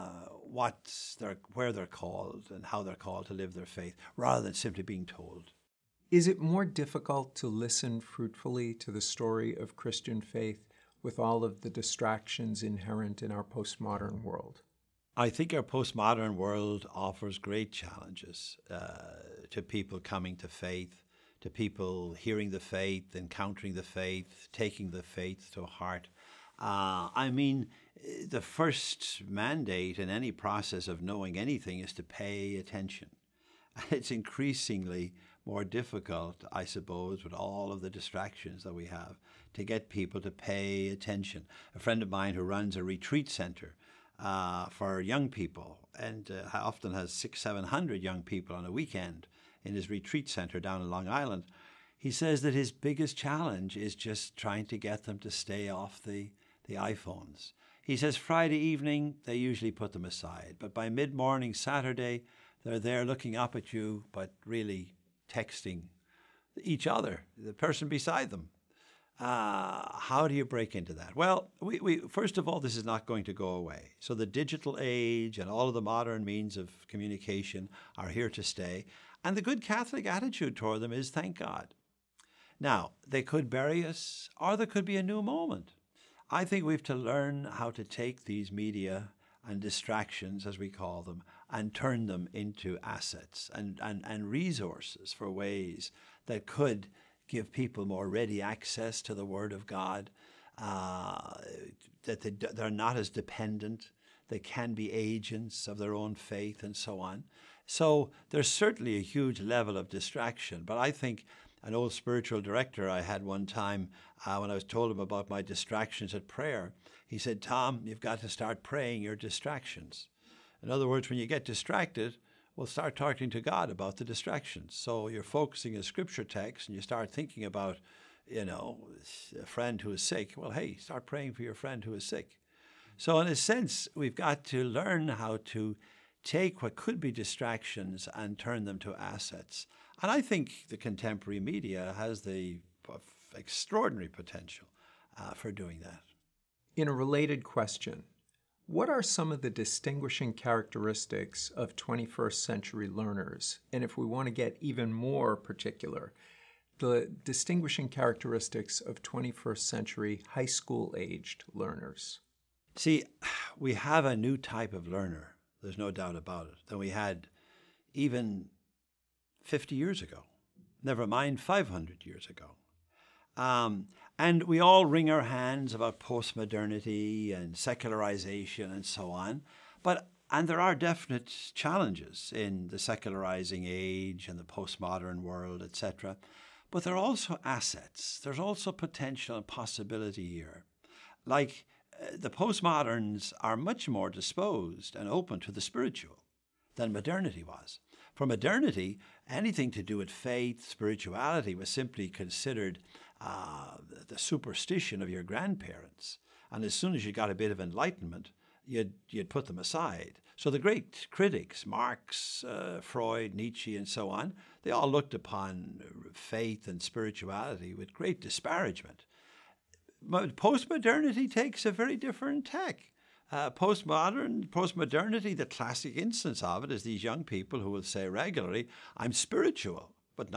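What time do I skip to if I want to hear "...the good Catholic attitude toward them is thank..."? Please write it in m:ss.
1:19.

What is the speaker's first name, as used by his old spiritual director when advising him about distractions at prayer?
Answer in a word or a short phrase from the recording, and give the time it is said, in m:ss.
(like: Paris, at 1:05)
Tom, at 1:57.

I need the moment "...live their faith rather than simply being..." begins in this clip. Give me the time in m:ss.
0:03.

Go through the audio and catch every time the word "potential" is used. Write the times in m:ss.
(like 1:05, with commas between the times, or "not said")
2:24, 3:08.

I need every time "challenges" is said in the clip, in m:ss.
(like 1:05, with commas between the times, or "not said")
0:17, 0:53, 3:01.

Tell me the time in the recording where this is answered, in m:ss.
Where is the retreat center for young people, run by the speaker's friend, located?
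0:50.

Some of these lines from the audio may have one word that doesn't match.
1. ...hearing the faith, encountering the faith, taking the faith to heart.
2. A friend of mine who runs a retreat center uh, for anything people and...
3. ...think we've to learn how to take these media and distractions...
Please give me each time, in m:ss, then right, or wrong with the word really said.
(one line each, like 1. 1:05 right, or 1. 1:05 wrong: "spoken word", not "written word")
1. 0:22 right
2. 0:41 wrong: "young", not "anything"
3. 1:26 right.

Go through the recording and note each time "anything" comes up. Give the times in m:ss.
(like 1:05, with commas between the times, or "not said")
0:31, 3:19.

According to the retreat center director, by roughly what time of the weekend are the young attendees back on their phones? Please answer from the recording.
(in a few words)
mid morning Saturday.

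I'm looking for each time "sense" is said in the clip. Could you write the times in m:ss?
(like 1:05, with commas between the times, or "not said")
2:13.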